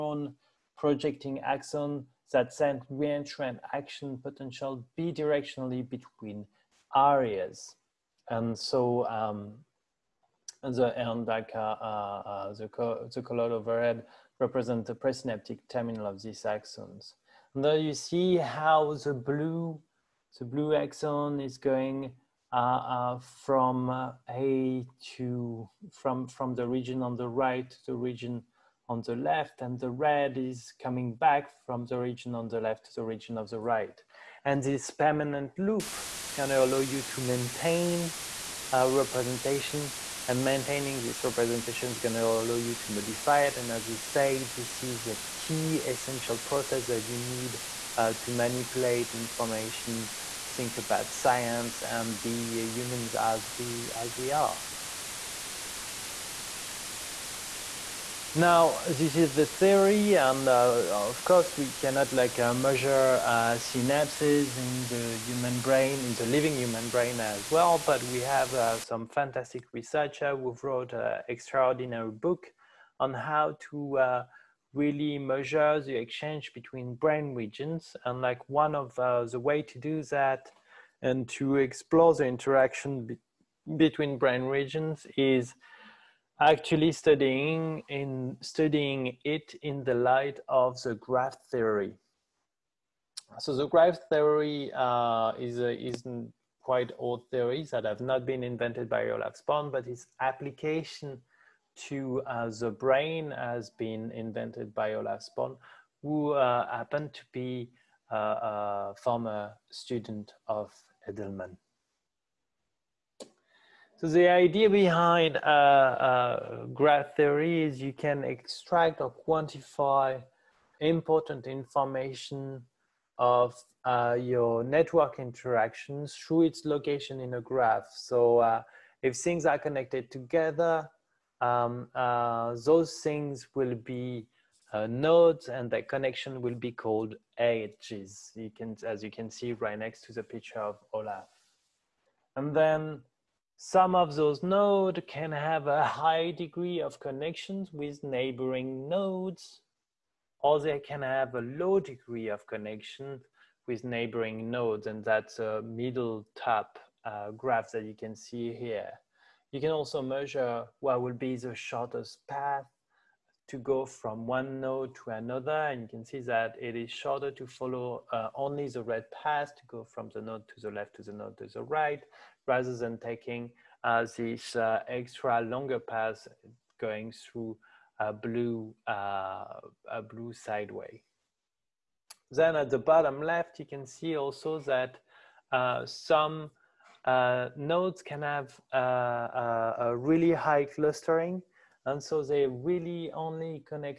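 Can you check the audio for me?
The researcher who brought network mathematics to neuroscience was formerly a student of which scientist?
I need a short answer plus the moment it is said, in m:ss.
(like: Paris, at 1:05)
Edelman, at 1:51.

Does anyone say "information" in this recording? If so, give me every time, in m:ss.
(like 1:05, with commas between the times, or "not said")
0:49, 2:01.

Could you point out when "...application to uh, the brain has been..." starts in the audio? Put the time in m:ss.
1:40.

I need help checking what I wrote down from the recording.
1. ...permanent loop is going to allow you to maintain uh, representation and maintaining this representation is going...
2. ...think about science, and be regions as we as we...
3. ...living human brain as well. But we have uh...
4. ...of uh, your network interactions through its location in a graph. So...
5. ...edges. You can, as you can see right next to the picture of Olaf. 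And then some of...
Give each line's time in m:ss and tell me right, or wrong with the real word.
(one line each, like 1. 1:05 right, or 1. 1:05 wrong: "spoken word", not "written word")
1. 0:34 right
2. 0:50 wrong: "humans", not "regions"
3. 1:06 right
4. 2:03 right
5. 2:17 right.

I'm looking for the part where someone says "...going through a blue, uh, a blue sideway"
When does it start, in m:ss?
2:56.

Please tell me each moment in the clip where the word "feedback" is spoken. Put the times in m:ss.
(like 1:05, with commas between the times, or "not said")
not said.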